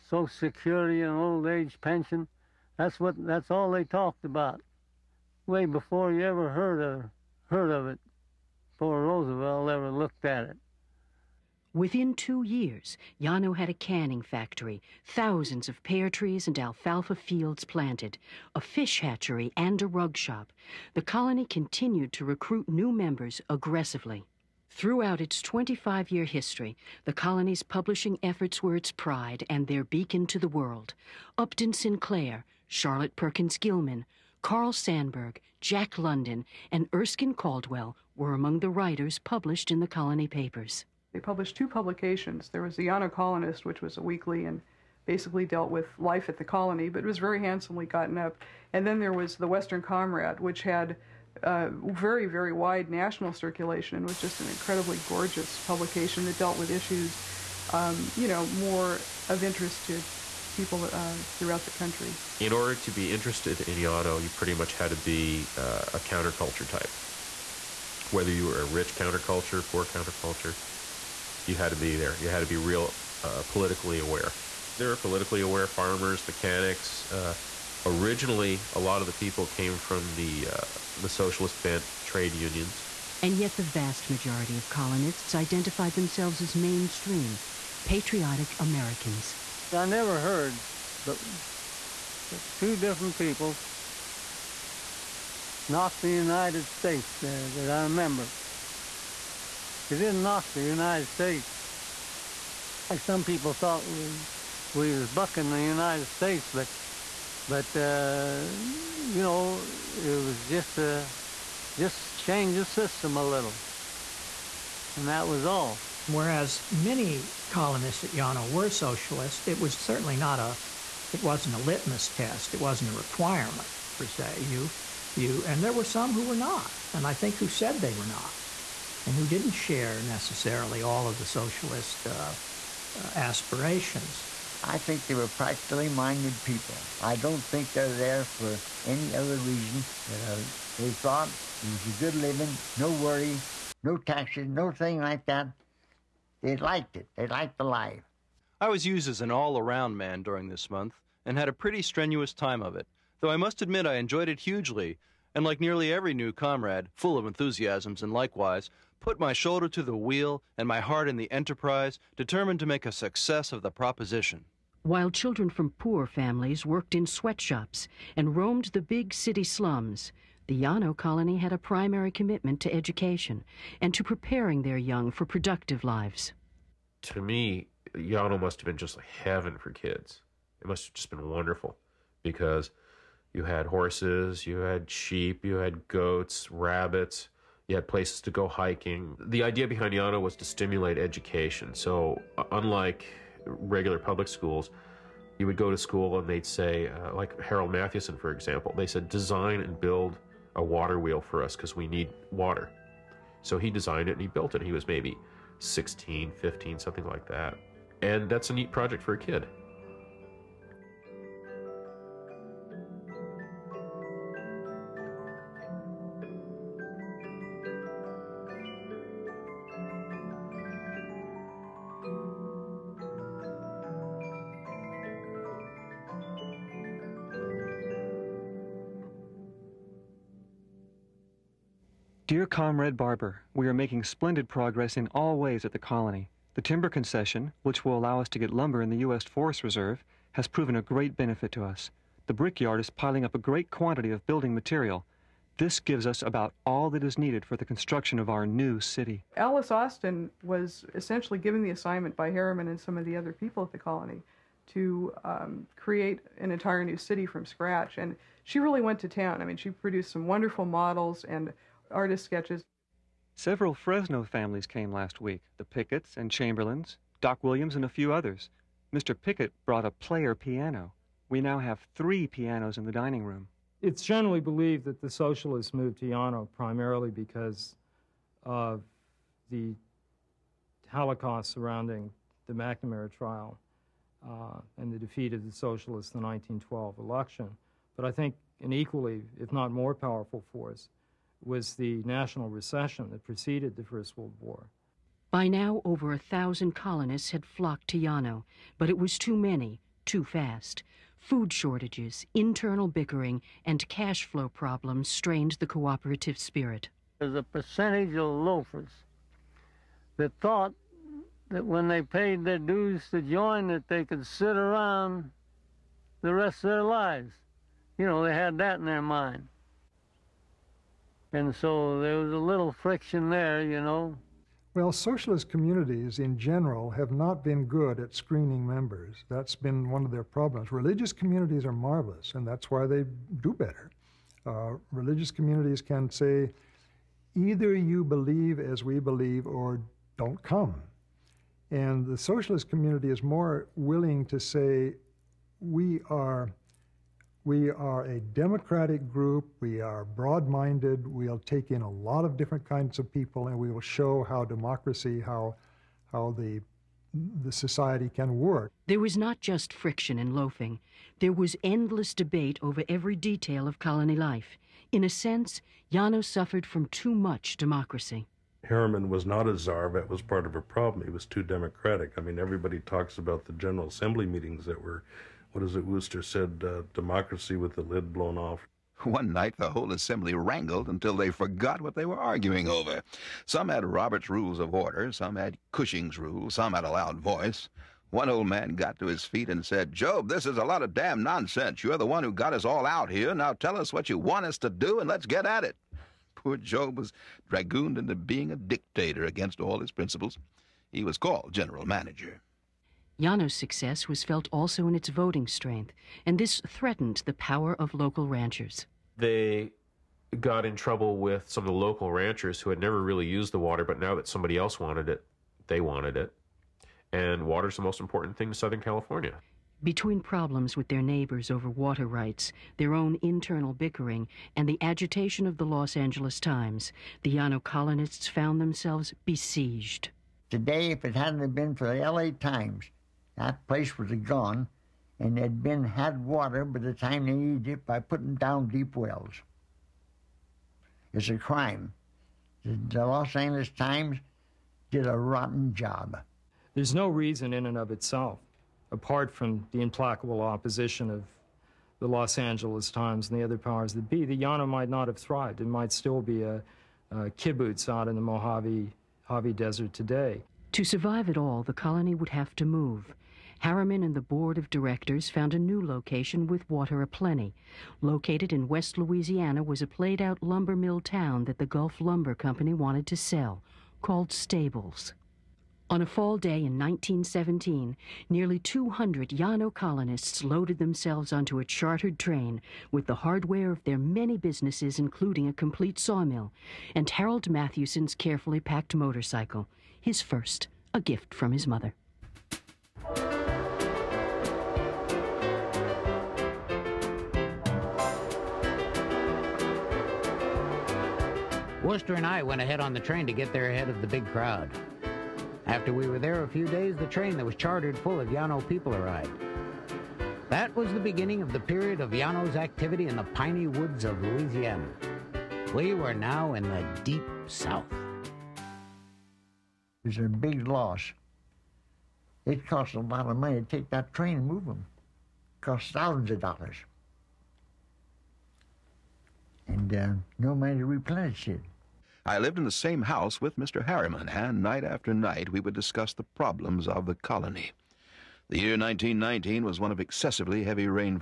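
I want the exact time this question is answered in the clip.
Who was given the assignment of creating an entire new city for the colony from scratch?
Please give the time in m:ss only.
4:09.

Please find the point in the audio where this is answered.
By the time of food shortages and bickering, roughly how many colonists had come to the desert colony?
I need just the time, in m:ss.
4:55.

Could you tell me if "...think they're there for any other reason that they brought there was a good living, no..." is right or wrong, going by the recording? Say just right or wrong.
wrong.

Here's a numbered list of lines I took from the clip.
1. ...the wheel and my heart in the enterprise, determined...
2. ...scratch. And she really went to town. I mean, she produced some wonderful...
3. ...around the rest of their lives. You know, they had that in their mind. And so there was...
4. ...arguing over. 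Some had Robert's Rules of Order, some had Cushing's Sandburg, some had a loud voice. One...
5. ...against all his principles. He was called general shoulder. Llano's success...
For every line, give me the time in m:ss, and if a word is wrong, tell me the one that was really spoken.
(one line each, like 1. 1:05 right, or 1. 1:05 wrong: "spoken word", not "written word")
1. 2:39 right
2. 4:17 right
3. 5:14 right
4. 6:22 wrong: "Rules", not "Sandburg"
5. 6:39 wrong: "manager", not "shoulder".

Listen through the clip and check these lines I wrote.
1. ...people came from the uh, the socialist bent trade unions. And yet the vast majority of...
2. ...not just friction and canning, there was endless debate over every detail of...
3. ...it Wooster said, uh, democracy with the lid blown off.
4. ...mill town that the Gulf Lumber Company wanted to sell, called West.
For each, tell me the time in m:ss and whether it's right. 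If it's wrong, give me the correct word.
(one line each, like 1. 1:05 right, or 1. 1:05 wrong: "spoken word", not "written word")
1. 1:19 right
2. 5:59 wrong: "loafing", not "canning"
3. 6:15 right
4. 7:50 wrong: "Stables", not "West".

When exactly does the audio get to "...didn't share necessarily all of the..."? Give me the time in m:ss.
2:09.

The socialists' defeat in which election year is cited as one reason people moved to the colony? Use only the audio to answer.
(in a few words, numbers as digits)
1912.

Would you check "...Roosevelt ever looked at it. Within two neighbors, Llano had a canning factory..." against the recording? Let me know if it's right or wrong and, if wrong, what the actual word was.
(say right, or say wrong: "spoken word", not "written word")
wrong: "years", not "neighbors".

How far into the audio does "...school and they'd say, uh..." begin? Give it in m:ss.
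3:15.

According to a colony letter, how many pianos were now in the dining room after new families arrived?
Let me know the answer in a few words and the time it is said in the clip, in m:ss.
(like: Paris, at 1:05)
3, at 4:31.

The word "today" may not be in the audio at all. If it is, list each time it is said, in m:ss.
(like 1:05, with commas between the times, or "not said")
7:10, 7:39.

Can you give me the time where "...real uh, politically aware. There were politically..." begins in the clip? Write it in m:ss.
1:12.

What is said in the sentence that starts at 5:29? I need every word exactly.
That's been one of their problems.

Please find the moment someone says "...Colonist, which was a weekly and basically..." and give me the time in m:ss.
0:43.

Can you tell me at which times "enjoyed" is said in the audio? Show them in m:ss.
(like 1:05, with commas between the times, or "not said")
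2:33.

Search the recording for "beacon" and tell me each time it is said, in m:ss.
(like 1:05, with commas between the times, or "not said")
0:29.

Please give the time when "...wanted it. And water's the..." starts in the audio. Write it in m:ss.
6:55.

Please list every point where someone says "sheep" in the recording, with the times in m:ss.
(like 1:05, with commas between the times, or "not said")
3:04.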